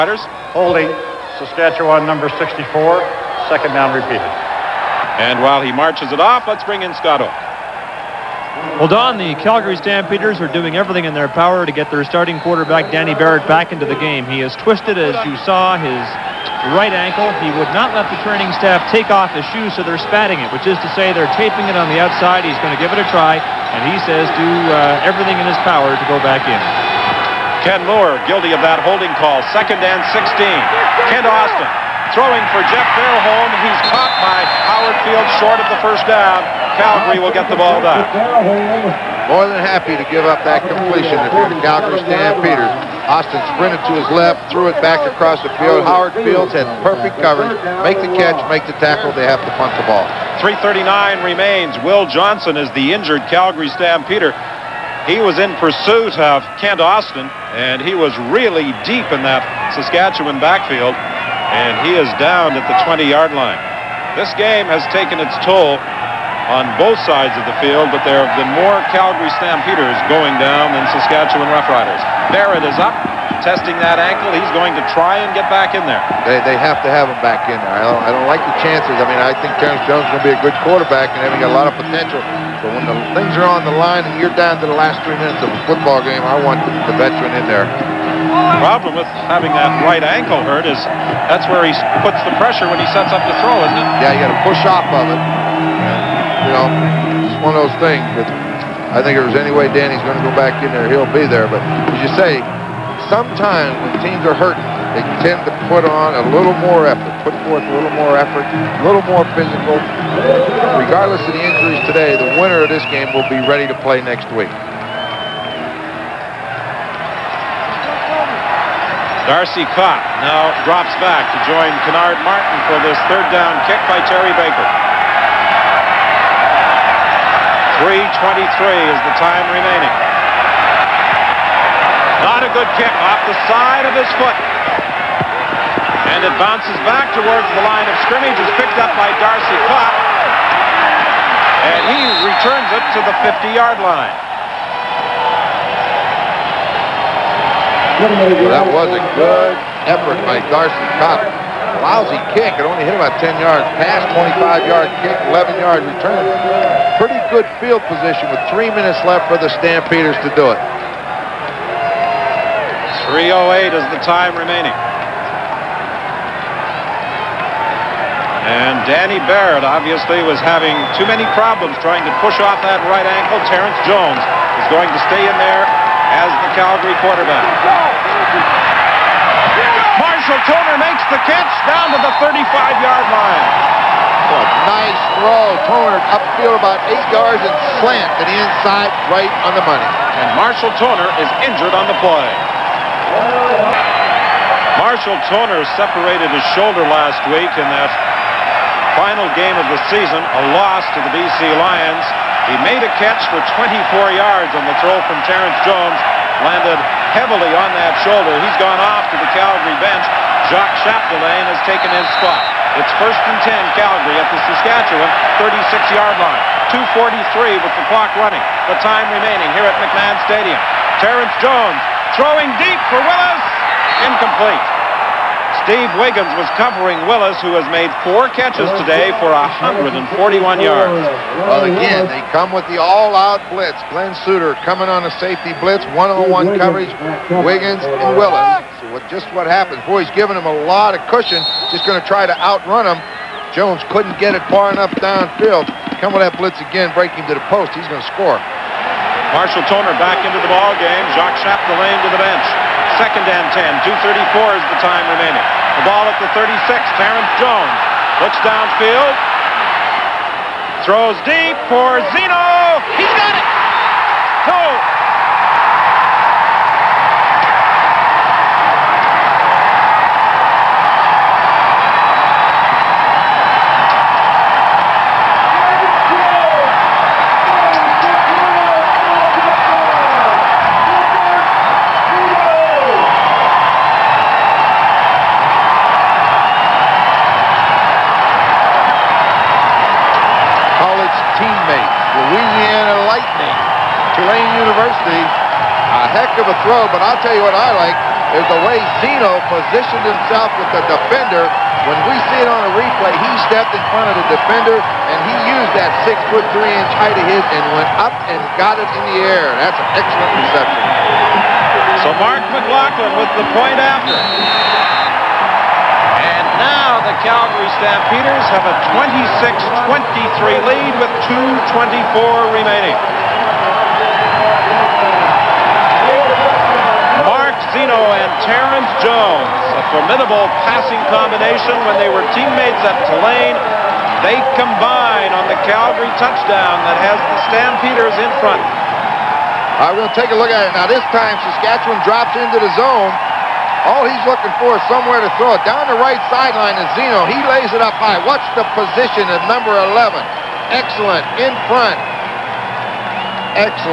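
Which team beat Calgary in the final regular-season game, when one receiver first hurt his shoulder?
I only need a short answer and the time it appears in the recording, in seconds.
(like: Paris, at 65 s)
BC Lions, at 201 s.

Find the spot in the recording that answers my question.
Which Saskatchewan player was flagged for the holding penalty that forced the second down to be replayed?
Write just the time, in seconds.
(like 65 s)
27 s.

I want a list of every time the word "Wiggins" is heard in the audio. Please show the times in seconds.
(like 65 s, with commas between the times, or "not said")
225 s, 237 s.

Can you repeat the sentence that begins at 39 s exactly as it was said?
More than happy to give up that completion if you're the Calgary Stampeders.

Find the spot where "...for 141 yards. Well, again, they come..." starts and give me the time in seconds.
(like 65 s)
229 s.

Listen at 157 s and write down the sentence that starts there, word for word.
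Pretty good field position with three minutes left for the Stampeders to do it.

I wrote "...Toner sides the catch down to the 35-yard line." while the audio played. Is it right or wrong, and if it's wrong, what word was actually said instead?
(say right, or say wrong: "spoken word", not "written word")
wrong: "makes", not "sides".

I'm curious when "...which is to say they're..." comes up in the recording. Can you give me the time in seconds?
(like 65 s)
20 s.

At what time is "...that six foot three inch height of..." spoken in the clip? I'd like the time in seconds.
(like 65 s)
305 s.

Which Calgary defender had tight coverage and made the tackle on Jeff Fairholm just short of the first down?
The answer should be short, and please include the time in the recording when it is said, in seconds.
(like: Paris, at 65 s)
Howard Field, at 34 s.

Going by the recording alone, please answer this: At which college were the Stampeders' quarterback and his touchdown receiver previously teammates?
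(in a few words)
Tulane.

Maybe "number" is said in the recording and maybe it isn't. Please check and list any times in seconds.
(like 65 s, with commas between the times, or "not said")
2 s, 349 s.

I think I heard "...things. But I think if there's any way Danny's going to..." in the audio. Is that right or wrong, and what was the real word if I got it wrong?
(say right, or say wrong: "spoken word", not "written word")
right.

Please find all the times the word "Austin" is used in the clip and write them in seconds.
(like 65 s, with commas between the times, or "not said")
31 s, 43 s, 56 s.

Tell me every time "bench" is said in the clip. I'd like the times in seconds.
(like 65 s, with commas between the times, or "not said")
209 s, 252 s.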